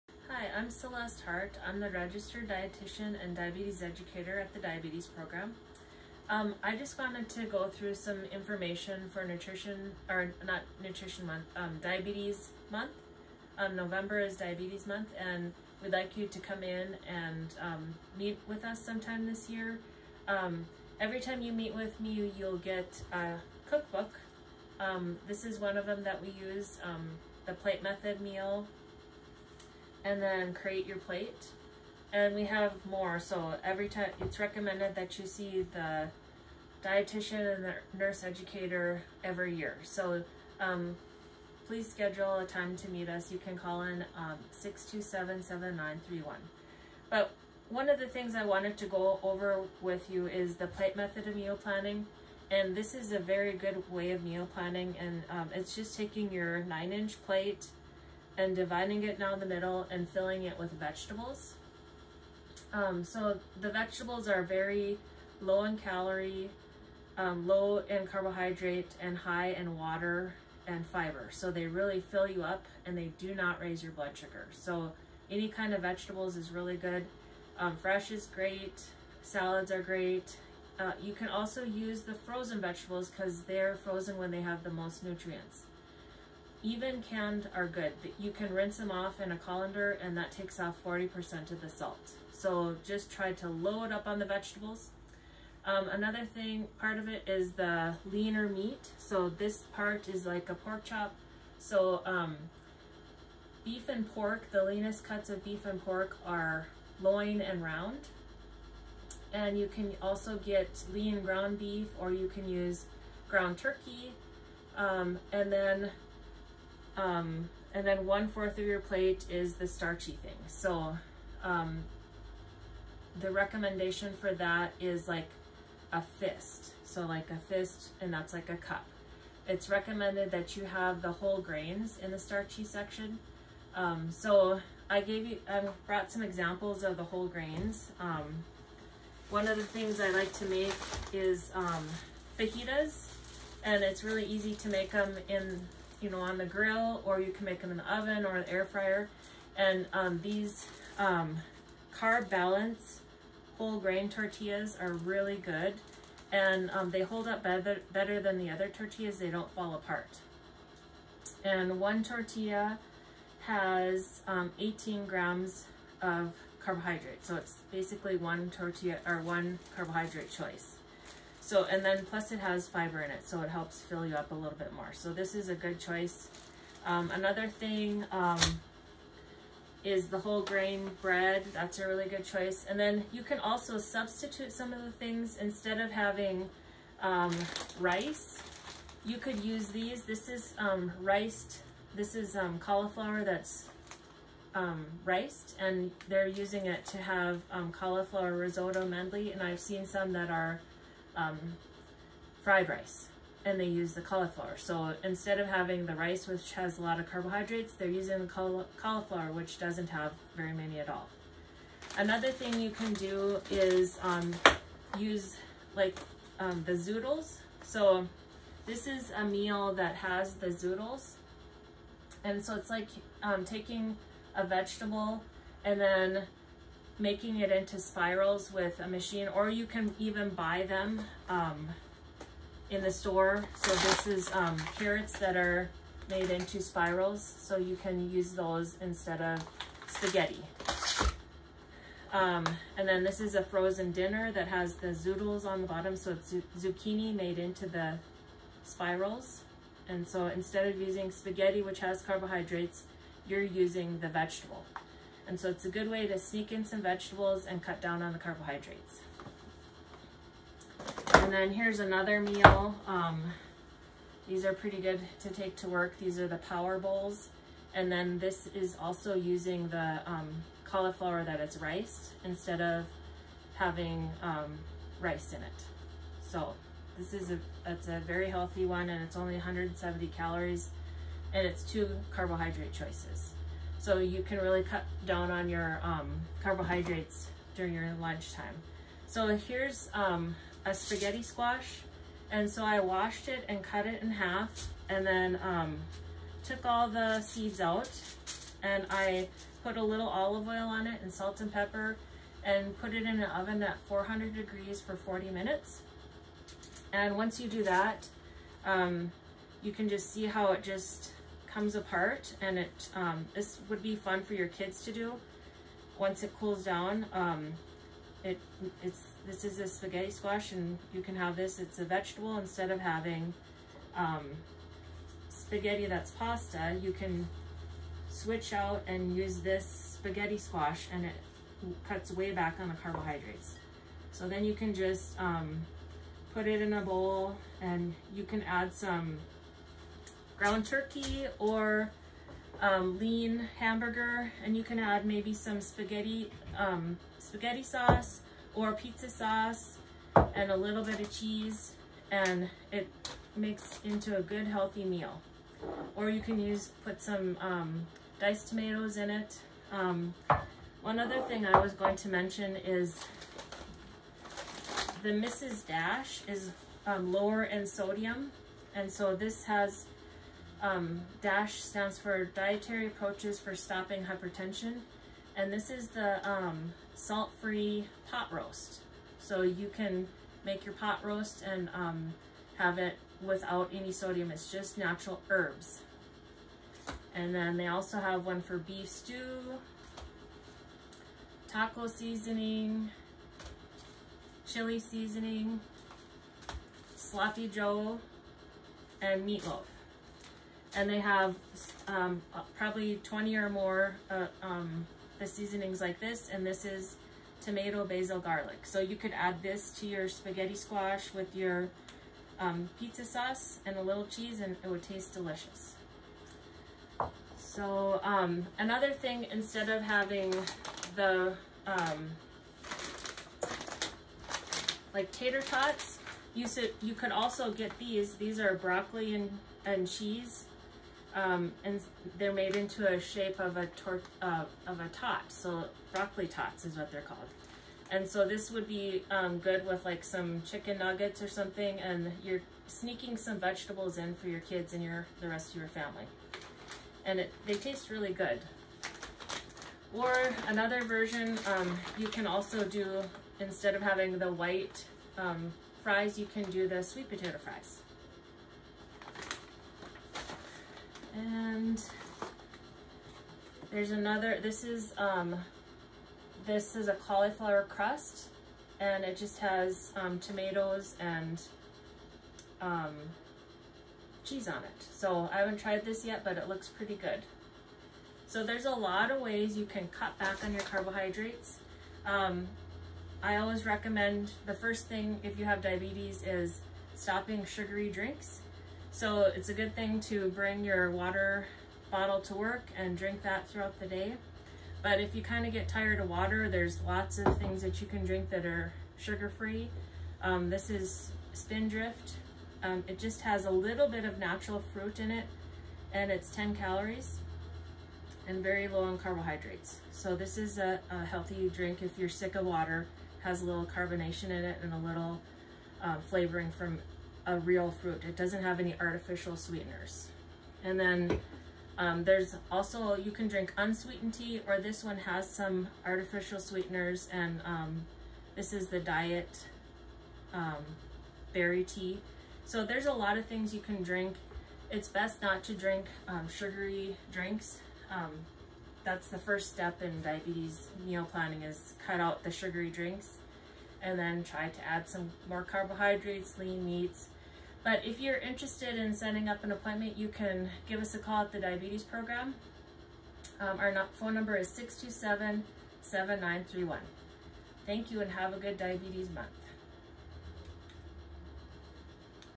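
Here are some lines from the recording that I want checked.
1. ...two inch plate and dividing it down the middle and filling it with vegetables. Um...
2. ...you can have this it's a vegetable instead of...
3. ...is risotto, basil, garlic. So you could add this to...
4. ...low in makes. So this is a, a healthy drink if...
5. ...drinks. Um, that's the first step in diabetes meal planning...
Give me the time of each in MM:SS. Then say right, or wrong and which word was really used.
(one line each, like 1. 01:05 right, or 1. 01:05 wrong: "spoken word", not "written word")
1. 00:56 wrong: "nine", not "two"
2. 05:20 right
3. 06:46 wrong: "tomato", not "risotto"
4. 08:28 wrong: "carbohydrates", not "makes"
5. 08:57 right.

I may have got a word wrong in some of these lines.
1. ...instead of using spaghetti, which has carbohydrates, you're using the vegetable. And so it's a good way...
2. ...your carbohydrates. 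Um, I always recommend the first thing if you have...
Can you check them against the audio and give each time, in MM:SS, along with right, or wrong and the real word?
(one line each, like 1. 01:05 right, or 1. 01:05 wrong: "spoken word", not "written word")
1. 04:10 right
2. 08:00 right.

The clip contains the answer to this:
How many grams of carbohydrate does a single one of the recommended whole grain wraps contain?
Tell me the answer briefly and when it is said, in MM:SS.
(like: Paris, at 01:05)
18, at 02:44.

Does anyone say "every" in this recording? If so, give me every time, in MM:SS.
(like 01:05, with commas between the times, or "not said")
00:20, 00:33, 00:39.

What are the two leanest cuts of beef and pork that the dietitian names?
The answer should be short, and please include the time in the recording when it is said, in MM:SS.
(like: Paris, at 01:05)
Loin and round, at 01:47.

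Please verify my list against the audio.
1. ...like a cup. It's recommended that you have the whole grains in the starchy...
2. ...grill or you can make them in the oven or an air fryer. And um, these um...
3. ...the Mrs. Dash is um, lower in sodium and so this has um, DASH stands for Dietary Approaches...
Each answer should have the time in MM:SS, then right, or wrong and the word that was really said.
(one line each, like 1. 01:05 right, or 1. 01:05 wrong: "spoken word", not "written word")
1. 02:08 right
2. 02:26 right
3. 06:05 right.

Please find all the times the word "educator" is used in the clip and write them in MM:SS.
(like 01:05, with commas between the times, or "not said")
00:03, 00:38.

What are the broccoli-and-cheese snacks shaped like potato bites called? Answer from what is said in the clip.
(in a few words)
Broccoli tots.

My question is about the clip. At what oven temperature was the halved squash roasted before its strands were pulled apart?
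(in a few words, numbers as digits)
400 degrees.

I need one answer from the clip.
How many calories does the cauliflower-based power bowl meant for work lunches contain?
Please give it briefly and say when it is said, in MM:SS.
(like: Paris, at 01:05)
170, at 04:39.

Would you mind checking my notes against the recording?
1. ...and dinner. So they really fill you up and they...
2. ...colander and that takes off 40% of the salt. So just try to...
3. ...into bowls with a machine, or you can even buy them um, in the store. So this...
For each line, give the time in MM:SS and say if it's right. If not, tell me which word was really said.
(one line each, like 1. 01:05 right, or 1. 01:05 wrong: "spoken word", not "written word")
1. 01:10 wrong: "fiber", not "dinner"
2. 01:29 right
3. 03:47 wrong: "spirals", not "bowls".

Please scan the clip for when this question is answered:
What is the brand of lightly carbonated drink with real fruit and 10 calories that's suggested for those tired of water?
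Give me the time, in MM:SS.
08:21.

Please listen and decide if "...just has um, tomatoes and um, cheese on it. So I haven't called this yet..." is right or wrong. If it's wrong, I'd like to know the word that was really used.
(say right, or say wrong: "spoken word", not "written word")
wrong: "tried", not "called".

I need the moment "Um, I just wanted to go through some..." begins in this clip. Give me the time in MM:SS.
00:06.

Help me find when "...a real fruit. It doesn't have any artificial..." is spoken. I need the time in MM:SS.
08:37.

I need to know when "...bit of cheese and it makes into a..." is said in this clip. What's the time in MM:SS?
05:50.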